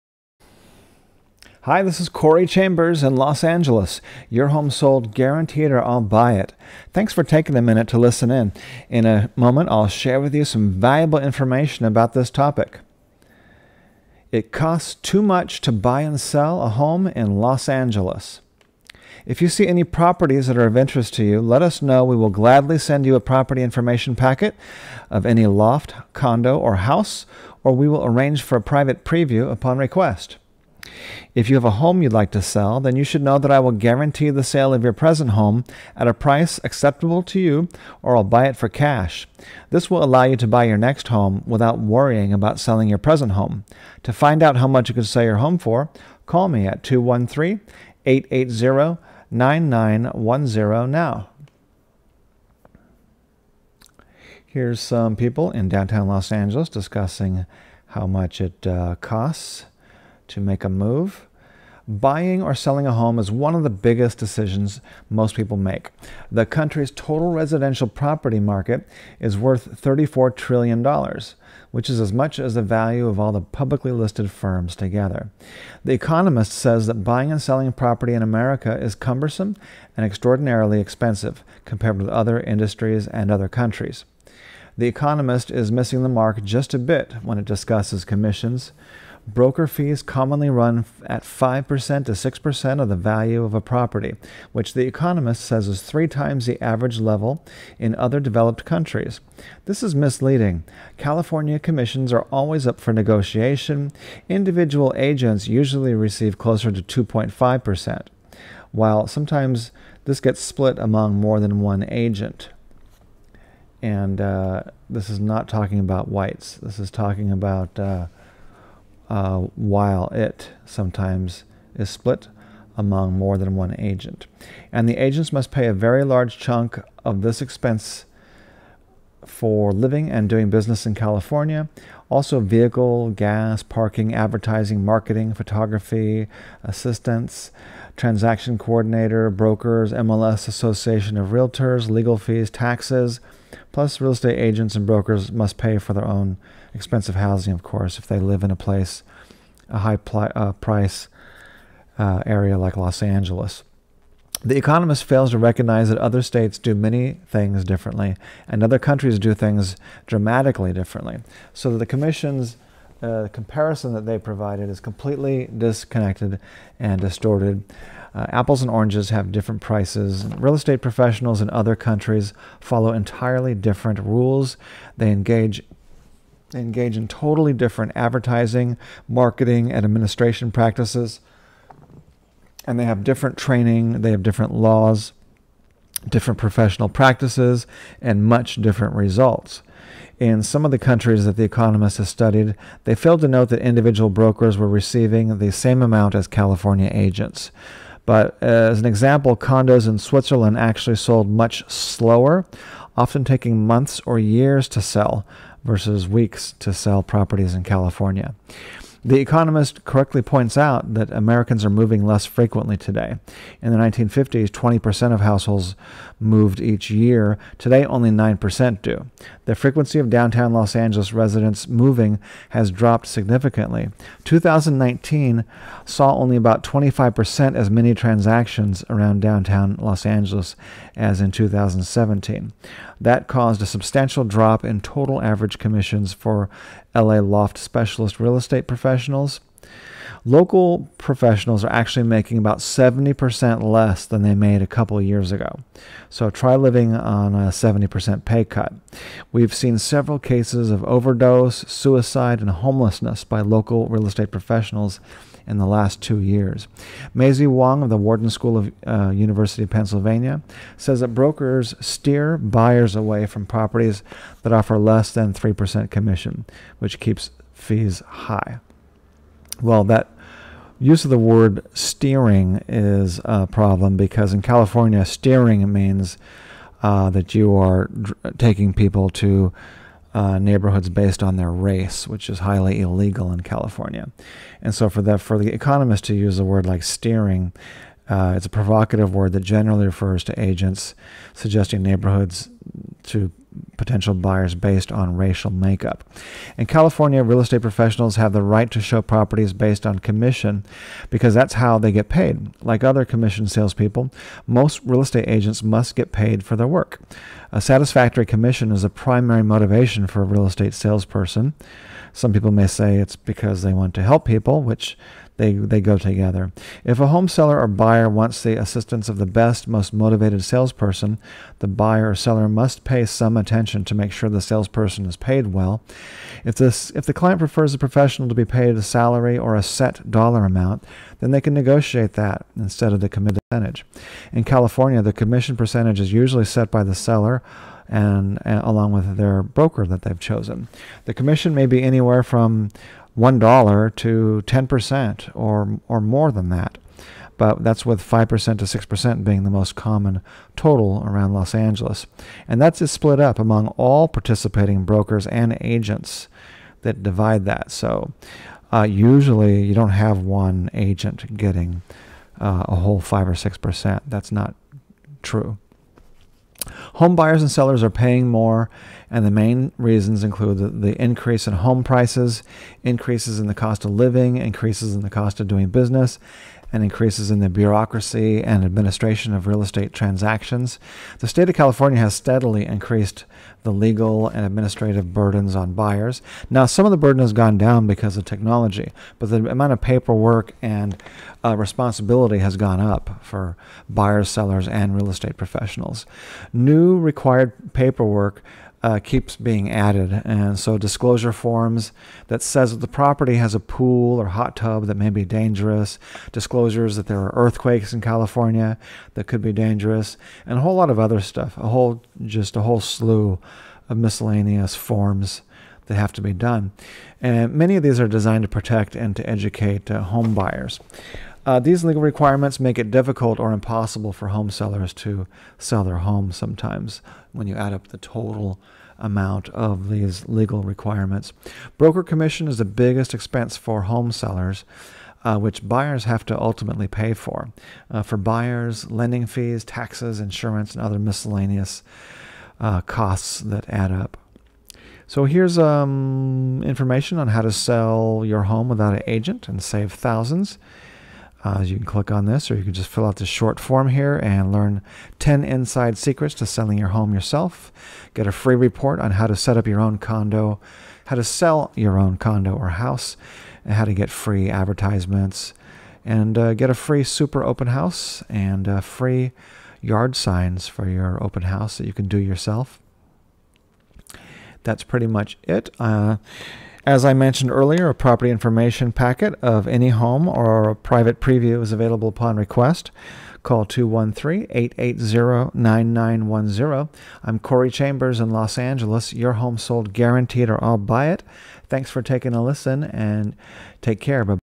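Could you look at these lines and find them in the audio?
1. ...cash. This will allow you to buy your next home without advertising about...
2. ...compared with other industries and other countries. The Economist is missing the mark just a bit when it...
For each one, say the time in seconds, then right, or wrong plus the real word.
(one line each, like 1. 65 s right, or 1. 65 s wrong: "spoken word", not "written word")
1. 38 s wrong: "worrying", not "advertising"
2. 81 s right.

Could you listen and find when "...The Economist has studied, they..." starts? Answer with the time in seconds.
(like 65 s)
191 s.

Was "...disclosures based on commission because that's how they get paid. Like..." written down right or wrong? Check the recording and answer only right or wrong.
wrong.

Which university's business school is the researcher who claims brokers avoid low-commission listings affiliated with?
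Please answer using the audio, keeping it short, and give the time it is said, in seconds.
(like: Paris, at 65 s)
Wharton School, at 257 s.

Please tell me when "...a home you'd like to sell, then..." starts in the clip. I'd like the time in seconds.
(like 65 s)
31 s.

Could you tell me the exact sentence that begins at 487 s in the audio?
I'm Corey Chambers in Los Angeles.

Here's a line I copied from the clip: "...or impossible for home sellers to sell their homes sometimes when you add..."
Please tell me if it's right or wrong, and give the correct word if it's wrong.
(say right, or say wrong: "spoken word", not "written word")
right.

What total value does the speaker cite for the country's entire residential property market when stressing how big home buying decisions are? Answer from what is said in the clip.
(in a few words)
$34 trillion.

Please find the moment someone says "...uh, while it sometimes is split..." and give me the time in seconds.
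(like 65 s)
119 s.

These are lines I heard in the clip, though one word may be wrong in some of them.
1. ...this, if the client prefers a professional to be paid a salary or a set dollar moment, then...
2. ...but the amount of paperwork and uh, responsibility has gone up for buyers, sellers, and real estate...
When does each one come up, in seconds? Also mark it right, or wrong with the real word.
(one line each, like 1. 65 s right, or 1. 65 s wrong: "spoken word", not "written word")
1. 326 s wrong: "amount", not "moment"
2. 389 s right.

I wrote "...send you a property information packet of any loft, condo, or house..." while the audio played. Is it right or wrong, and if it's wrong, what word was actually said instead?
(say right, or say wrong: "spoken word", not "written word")
right.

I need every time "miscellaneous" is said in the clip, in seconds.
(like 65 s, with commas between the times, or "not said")
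413 s, 440 s.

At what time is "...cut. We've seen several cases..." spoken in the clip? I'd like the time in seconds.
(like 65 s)
248 s.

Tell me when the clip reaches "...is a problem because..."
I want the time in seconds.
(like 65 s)
272 s.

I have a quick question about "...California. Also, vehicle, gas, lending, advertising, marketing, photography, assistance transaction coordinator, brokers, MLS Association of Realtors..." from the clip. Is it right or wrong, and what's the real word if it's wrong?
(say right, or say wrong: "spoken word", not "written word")
wrong: "parking", not "lending".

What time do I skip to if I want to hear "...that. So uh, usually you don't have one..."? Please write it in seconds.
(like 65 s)
357 s.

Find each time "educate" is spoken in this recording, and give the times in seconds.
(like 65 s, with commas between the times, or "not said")
419 s.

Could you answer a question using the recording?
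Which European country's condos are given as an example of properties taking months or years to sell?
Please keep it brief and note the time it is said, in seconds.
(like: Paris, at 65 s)
Switzerland, at 199 s.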